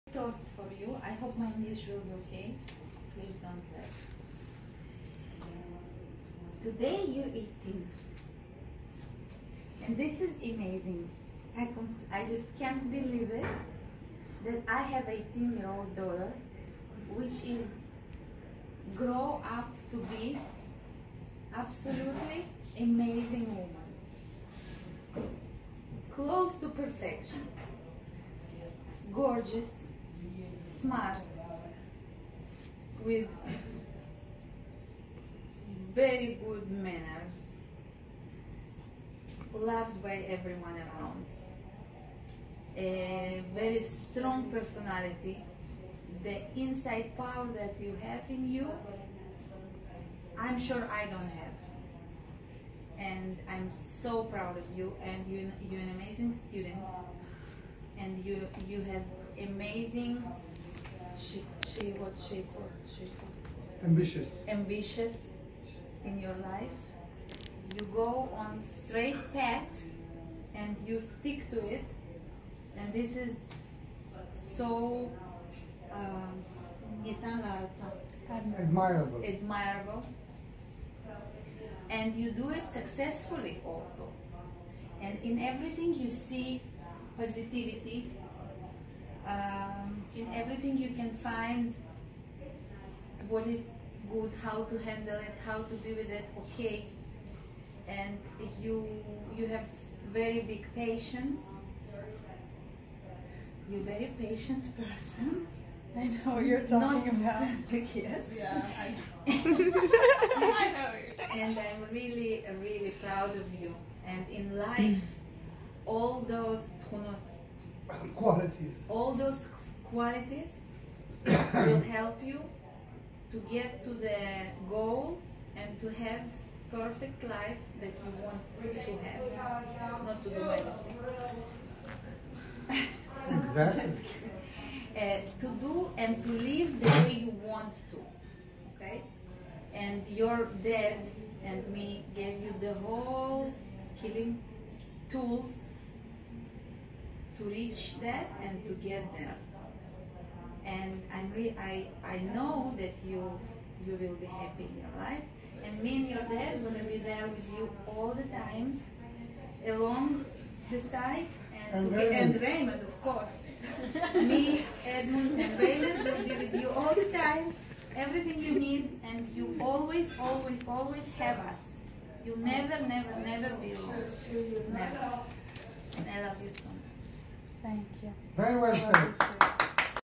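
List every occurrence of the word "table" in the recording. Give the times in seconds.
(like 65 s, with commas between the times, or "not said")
not said.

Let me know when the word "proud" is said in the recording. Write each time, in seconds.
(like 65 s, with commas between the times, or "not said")
54 s, 113 s.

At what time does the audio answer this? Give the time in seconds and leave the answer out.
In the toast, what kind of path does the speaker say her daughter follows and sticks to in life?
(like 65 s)
68 s.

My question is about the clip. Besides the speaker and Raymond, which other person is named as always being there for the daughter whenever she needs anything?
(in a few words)
Edmund.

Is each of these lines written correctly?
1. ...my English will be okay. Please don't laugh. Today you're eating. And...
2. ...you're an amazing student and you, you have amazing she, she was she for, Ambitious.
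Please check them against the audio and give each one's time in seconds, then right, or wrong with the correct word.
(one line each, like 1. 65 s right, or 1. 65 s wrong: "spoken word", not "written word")
1. 1 s right
2. 55 s right.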